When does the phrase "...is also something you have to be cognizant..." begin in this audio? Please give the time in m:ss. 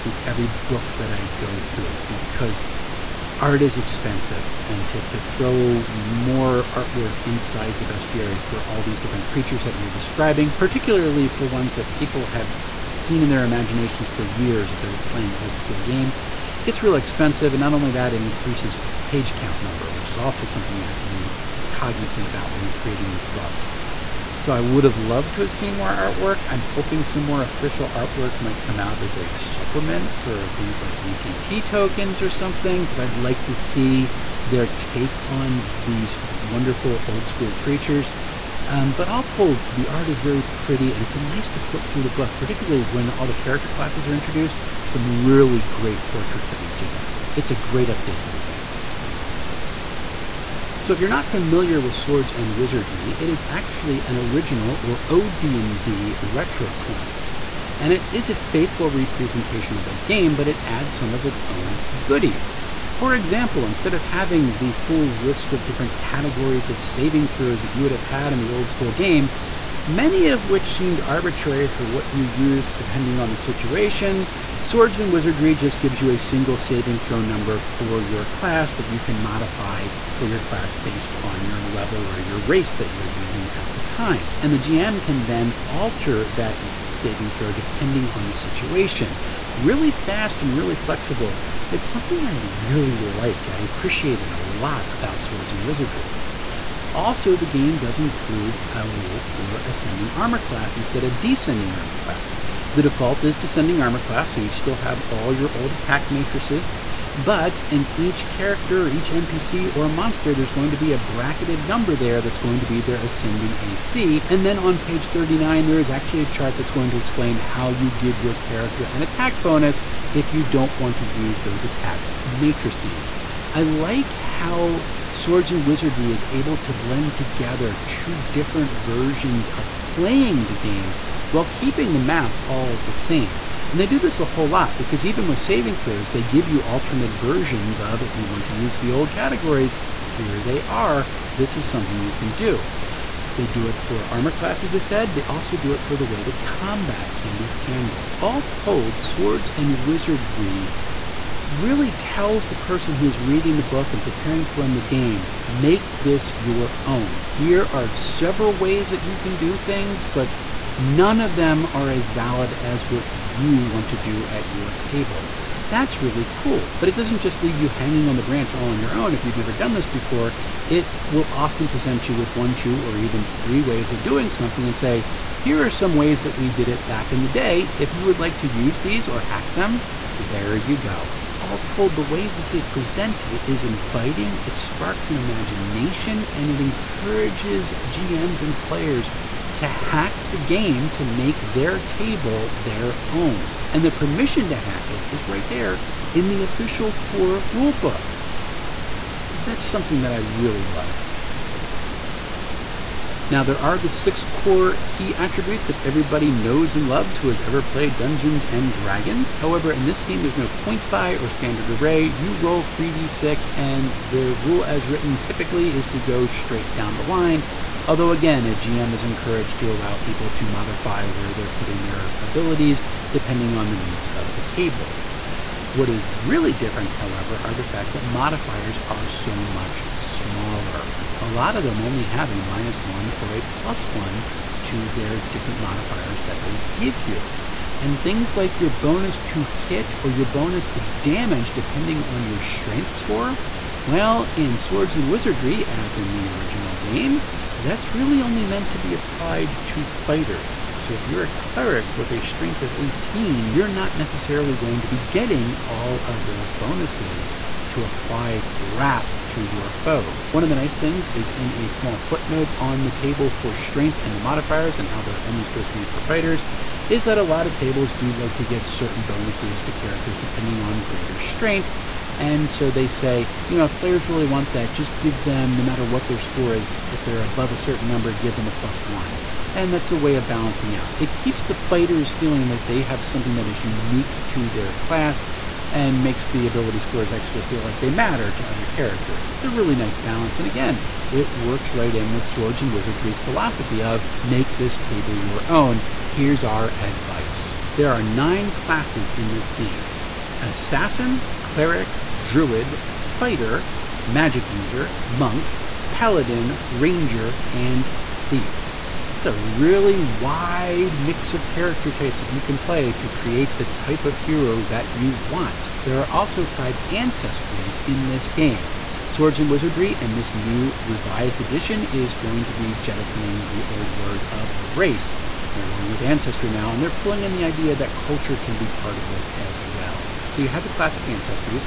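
0:20.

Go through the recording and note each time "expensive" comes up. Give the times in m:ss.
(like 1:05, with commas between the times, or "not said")
0:03, 0:16.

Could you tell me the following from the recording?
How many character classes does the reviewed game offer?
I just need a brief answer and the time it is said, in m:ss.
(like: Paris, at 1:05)
9, at 4:58.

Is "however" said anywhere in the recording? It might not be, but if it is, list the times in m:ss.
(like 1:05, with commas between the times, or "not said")
3:29, 3:46.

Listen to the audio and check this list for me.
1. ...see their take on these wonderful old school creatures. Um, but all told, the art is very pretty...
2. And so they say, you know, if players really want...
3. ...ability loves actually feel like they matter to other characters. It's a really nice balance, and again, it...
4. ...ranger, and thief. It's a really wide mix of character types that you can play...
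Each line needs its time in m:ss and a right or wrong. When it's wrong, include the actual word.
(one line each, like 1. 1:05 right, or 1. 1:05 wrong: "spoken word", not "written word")
1. 0:33 right
2. 4:32 right
3. 4:46 wrong: "scores", not "loves"
4. 5:06 right.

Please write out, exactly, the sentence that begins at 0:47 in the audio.
It's a great update to the game.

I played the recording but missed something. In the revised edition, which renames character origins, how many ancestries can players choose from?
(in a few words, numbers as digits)
5.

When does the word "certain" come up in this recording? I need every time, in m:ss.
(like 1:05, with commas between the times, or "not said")
4:28, 4:37.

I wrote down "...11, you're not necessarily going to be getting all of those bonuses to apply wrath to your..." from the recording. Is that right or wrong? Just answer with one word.
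wrong.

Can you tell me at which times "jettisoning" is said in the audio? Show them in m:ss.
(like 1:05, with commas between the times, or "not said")
5:22.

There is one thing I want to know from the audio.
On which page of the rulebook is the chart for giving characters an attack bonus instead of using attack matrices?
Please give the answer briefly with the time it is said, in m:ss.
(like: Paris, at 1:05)
39, at 1:54.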